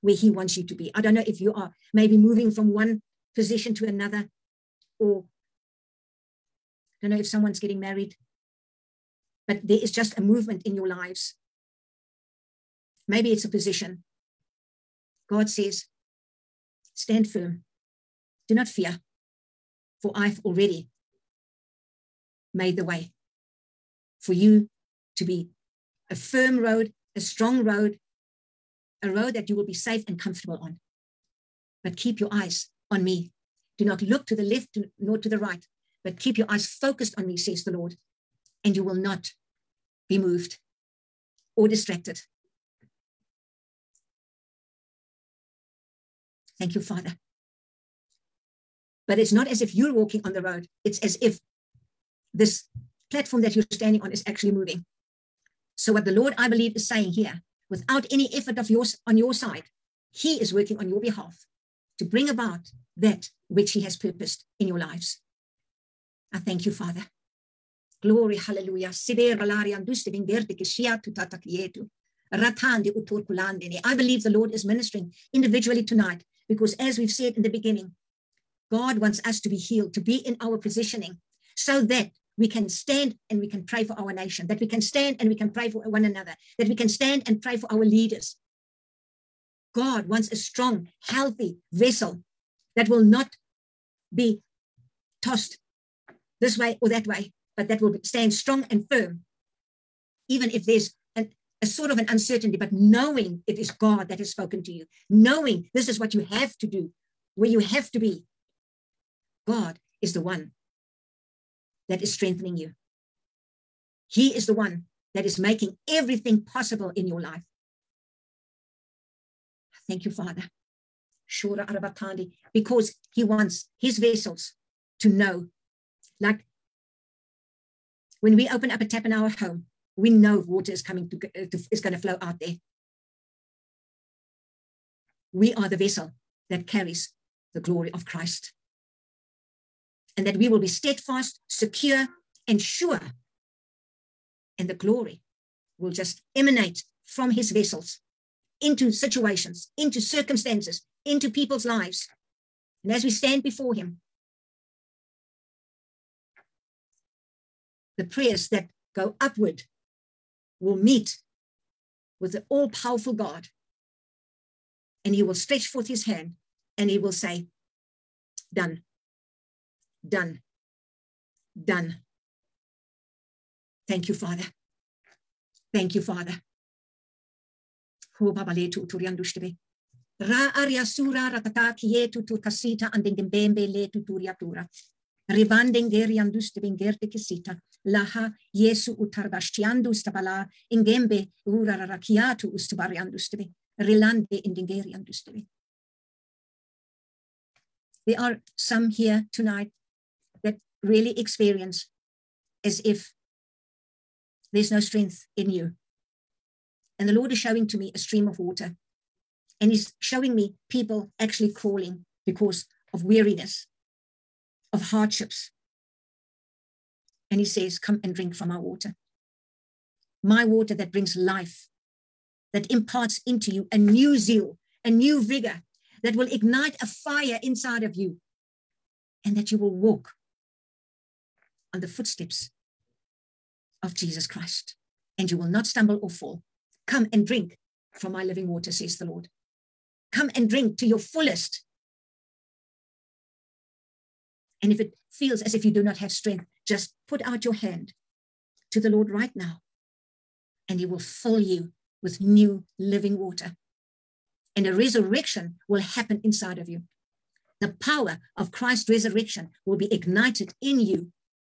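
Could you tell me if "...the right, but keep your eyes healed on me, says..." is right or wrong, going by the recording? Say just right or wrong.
wrong.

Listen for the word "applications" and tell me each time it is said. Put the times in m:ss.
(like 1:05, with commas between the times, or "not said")
not said.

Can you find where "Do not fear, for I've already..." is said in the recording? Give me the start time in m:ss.
0:18.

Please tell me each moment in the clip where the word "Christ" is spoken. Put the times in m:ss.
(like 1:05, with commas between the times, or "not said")
2:18, 3:54, 4:18.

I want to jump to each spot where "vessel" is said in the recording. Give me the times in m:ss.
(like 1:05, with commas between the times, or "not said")
1:31, 2:03, 2:15, 2:27.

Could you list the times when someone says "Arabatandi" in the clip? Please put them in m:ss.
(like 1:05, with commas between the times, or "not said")
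2:01.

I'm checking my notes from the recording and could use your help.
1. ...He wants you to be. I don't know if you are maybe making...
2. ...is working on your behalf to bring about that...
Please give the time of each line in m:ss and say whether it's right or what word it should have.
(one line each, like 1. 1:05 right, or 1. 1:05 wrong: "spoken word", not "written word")
1. 0:00 wrong: "moving", not "making"
2. 1:00 right.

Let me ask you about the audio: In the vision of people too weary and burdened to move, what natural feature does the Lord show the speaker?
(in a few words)
A stream of water.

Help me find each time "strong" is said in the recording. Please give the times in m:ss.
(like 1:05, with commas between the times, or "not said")
0:27, 1:30, 1:38.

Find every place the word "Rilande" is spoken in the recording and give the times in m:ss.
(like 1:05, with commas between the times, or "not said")
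3:13.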